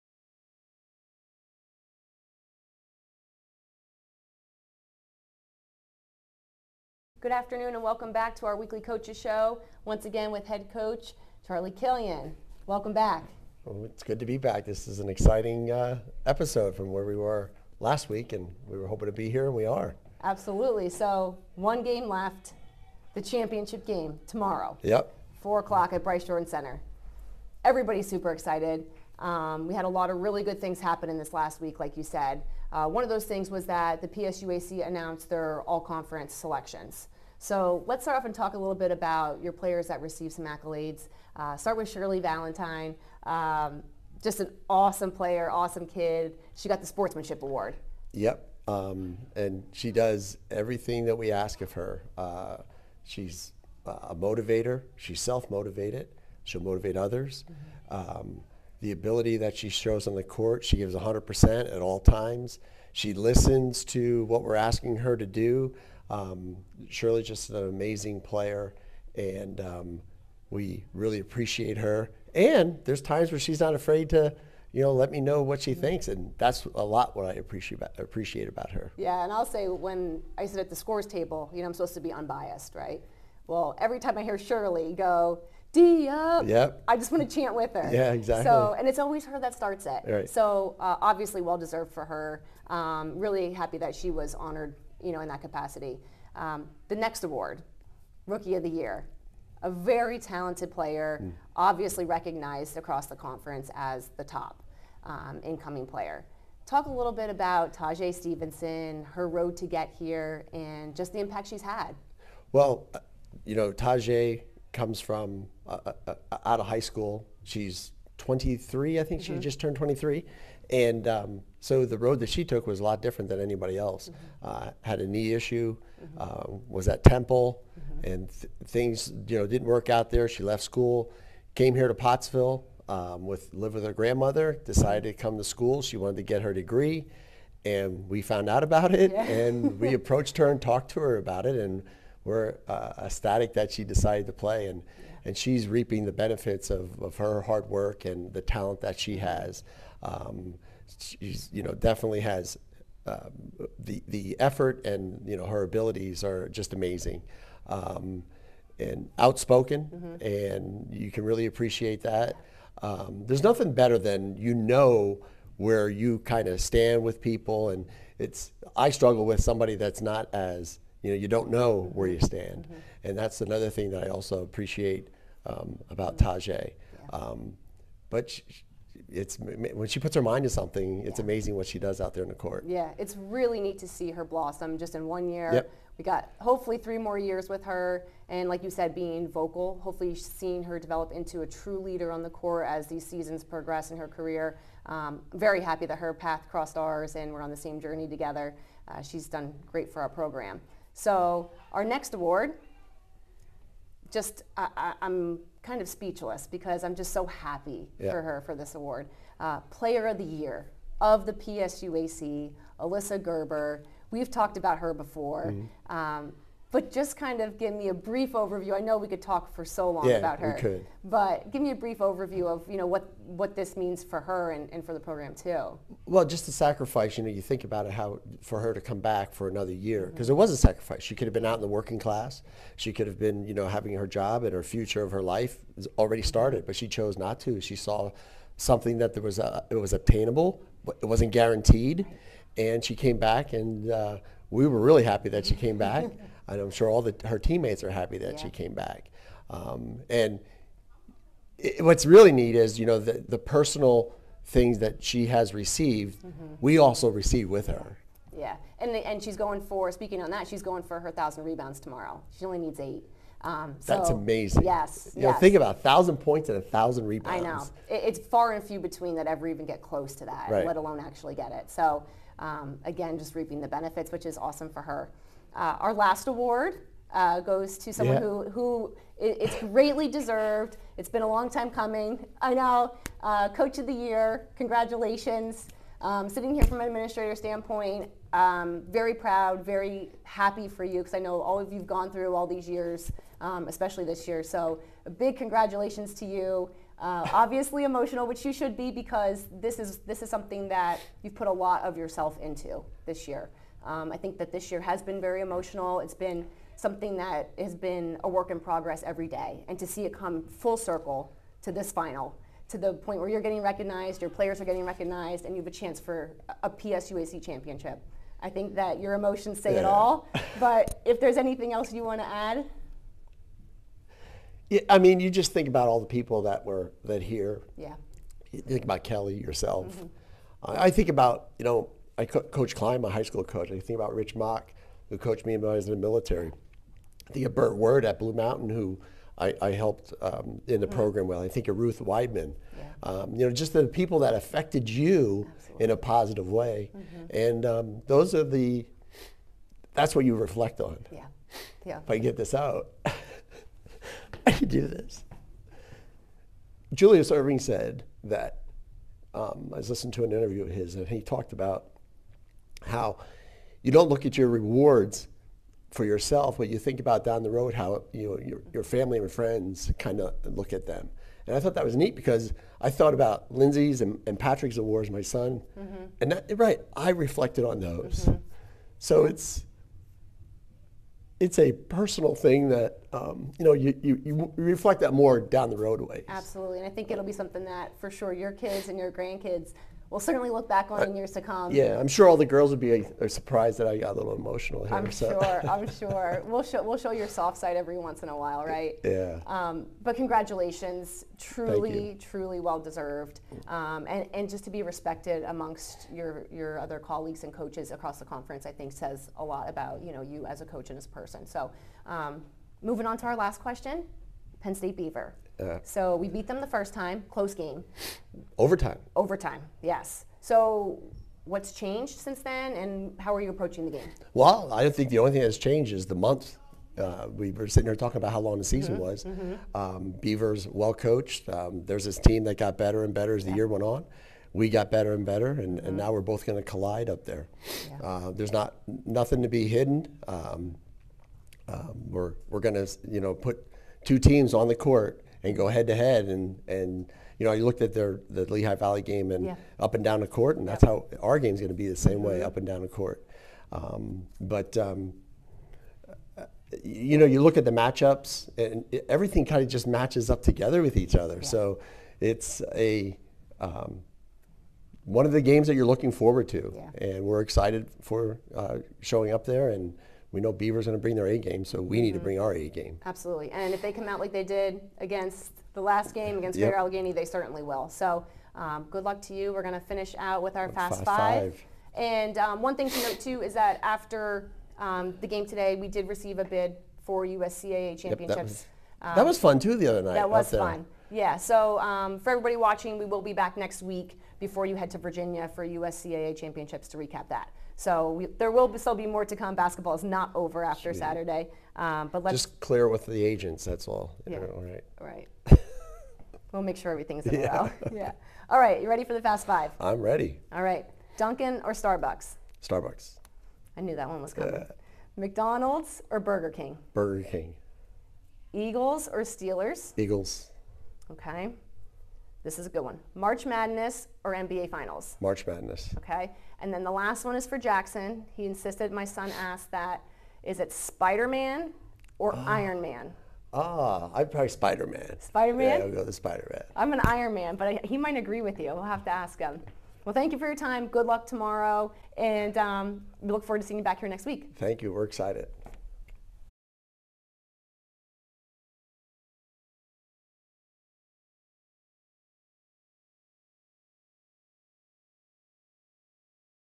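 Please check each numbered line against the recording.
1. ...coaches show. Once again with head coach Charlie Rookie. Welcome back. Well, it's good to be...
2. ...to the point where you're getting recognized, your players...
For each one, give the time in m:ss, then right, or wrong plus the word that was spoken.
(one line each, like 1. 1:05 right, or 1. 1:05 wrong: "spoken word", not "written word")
1. 0:08 wrong: "Killian", not "Rookie"
2. 5:12 right.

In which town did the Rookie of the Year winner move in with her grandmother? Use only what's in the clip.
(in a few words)
Pottsville.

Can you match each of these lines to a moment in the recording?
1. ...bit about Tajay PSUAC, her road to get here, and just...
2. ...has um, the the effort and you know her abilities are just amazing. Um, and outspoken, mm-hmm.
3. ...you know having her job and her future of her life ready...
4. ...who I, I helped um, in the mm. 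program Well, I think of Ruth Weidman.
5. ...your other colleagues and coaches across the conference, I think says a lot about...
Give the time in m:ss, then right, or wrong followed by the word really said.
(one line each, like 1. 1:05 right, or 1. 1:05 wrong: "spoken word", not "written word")
1. 1:47 wrong: "Stevenson", not "PSUAC"
2. 2:32 right
3. 3:53 wrong: "already", not "ready"
4. 5:38 right
5. 6:46 right.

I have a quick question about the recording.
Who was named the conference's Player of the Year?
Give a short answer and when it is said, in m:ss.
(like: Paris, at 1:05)
Alyssa Gerber, at 3:32.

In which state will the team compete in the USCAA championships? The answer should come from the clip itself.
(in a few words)
Virginia.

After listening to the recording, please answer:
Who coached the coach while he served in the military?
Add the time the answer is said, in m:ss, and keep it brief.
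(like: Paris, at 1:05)
Rich Mock, at 5:34.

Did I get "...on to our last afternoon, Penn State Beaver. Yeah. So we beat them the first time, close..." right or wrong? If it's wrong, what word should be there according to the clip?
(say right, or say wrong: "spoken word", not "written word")
wrong: "question", not "afternoon".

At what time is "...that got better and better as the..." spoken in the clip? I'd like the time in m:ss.
7:12.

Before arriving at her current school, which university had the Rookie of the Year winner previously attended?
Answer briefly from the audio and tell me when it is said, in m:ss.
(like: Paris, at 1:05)
Temple, at 2:07.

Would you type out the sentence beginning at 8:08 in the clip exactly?
Yep, that, was, that, was, fun, too, the other night.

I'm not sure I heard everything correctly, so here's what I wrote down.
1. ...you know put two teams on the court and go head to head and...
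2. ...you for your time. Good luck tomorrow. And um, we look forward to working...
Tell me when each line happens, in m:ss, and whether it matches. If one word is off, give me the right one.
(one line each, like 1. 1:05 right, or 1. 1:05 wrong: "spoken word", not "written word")
1. 7:23 right
2. 9:00 wrong: "seeing", not "working".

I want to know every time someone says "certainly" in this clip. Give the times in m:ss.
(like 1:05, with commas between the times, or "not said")
6:30, 7:57.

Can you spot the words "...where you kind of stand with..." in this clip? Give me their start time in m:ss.
2:45.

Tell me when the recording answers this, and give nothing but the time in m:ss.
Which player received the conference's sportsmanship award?
0:41.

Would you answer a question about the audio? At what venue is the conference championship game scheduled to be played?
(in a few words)
Bryce Jordan Center.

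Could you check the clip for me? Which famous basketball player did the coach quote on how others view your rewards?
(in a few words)
Julius Erving.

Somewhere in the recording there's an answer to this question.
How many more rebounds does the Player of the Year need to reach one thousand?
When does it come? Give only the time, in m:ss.
4:22.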